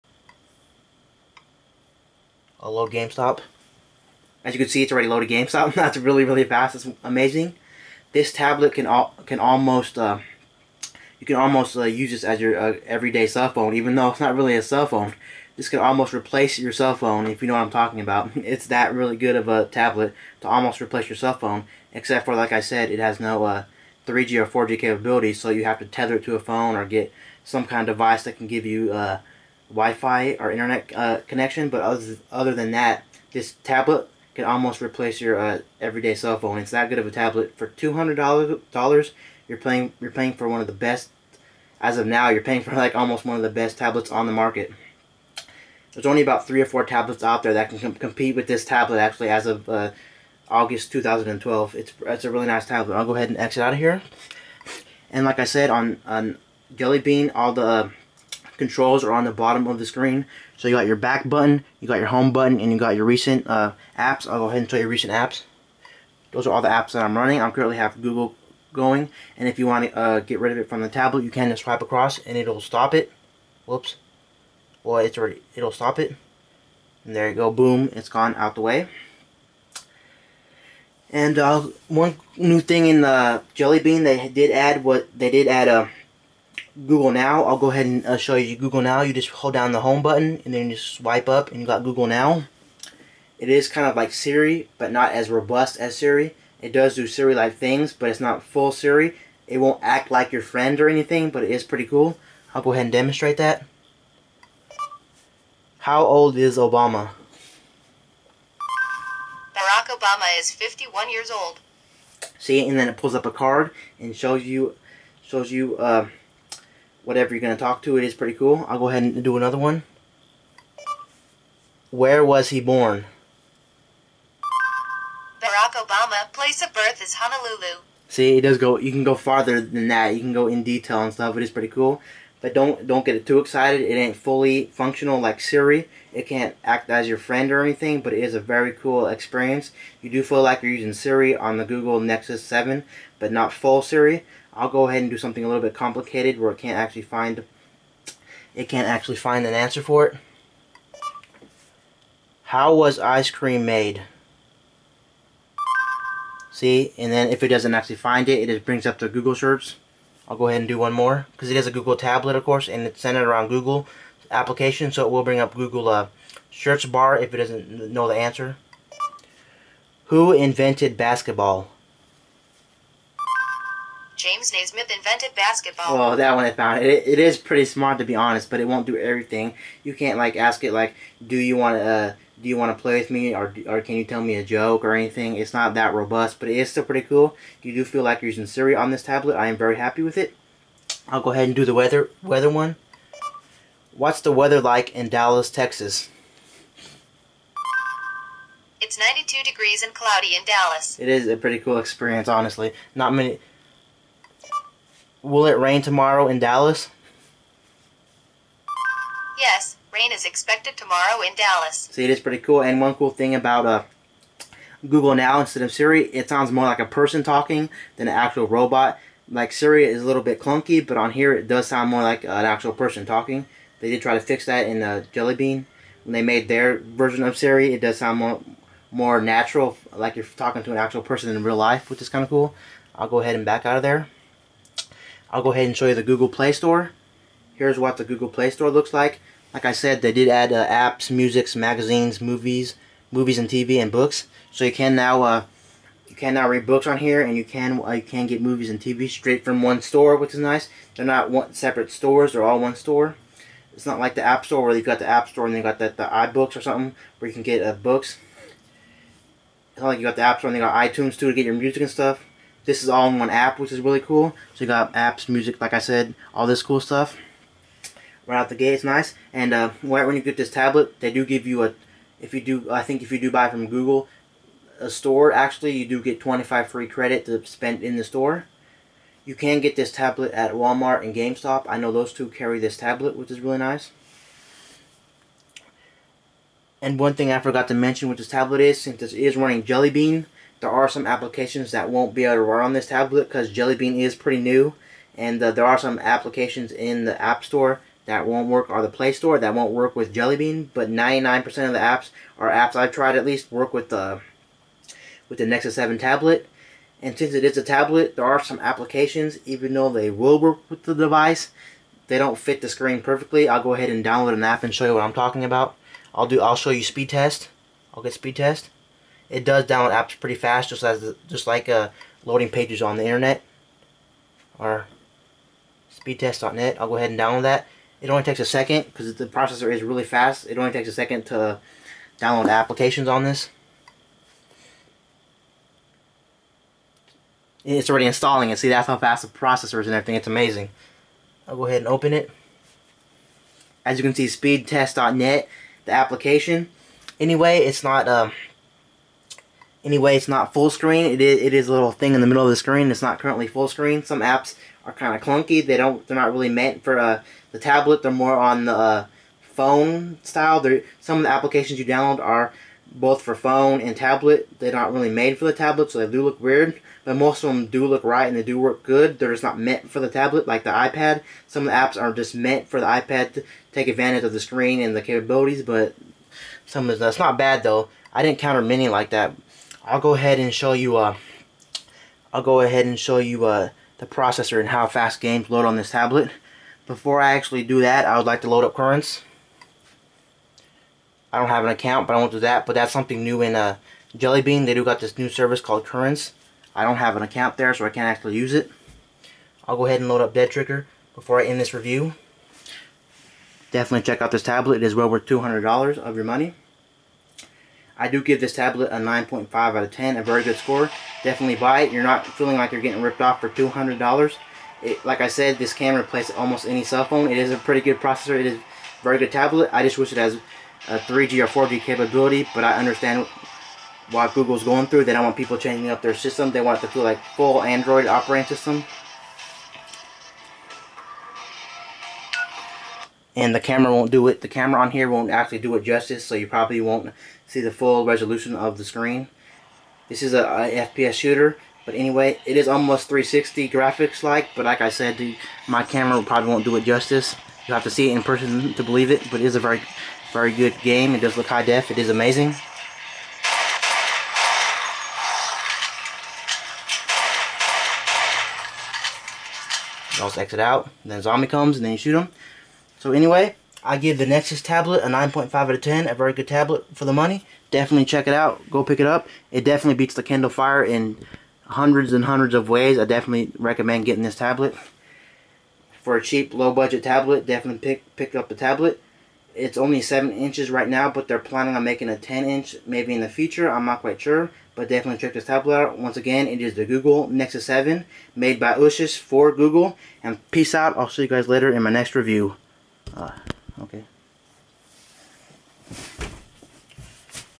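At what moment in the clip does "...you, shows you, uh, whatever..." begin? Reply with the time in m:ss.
1:54.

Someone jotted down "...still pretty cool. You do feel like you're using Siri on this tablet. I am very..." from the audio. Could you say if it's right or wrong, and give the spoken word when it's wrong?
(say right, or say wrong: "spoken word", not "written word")
right.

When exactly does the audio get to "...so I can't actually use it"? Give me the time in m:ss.
6:37.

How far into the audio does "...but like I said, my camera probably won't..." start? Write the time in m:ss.
7:24.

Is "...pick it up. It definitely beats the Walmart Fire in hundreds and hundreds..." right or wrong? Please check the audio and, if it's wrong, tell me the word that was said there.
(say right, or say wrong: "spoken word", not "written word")
wrong: "Kindle", not "Walmart".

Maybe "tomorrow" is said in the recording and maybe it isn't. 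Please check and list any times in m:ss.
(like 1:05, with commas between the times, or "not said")
3:25, 3:30.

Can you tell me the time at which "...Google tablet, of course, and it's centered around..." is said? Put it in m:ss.
2:41.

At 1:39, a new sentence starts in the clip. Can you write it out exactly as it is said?
It won't act like your friend or anything, but it is pretty cool.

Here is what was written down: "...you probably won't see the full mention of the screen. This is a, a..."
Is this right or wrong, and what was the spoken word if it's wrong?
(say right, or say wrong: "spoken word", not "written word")
wrong: "resolution", not "mention".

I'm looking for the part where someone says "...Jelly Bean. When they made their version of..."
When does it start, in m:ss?
3:45.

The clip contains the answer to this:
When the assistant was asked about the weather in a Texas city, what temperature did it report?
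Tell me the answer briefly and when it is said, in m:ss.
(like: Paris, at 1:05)
92 degrees, at 3:18.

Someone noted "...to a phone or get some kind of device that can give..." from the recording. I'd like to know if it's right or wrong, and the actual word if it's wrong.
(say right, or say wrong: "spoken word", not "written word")
right.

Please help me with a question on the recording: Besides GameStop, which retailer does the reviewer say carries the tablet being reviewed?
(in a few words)
Walmart.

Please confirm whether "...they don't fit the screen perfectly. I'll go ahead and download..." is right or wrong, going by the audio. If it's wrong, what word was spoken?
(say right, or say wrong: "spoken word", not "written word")
right.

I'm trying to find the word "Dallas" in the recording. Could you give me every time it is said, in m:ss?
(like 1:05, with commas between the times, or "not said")
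3:15, 3:20, 3:26, 3:31.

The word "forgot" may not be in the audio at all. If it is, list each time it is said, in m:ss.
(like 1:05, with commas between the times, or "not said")
4:47.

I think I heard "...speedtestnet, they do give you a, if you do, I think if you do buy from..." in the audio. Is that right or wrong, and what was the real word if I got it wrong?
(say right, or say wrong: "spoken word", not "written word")
wrong: "tablet", not "speedtestnet".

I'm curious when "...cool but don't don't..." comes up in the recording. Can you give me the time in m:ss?
2:11.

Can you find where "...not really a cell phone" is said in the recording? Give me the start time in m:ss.
0:14.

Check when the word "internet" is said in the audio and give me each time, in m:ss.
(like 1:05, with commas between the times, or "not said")
0:30, 5:23.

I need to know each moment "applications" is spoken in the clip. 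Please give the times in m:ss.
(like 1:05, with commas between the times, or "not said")
2:44, 4:51, 4:55, 5:08, 5:32, 5:45, 6:01.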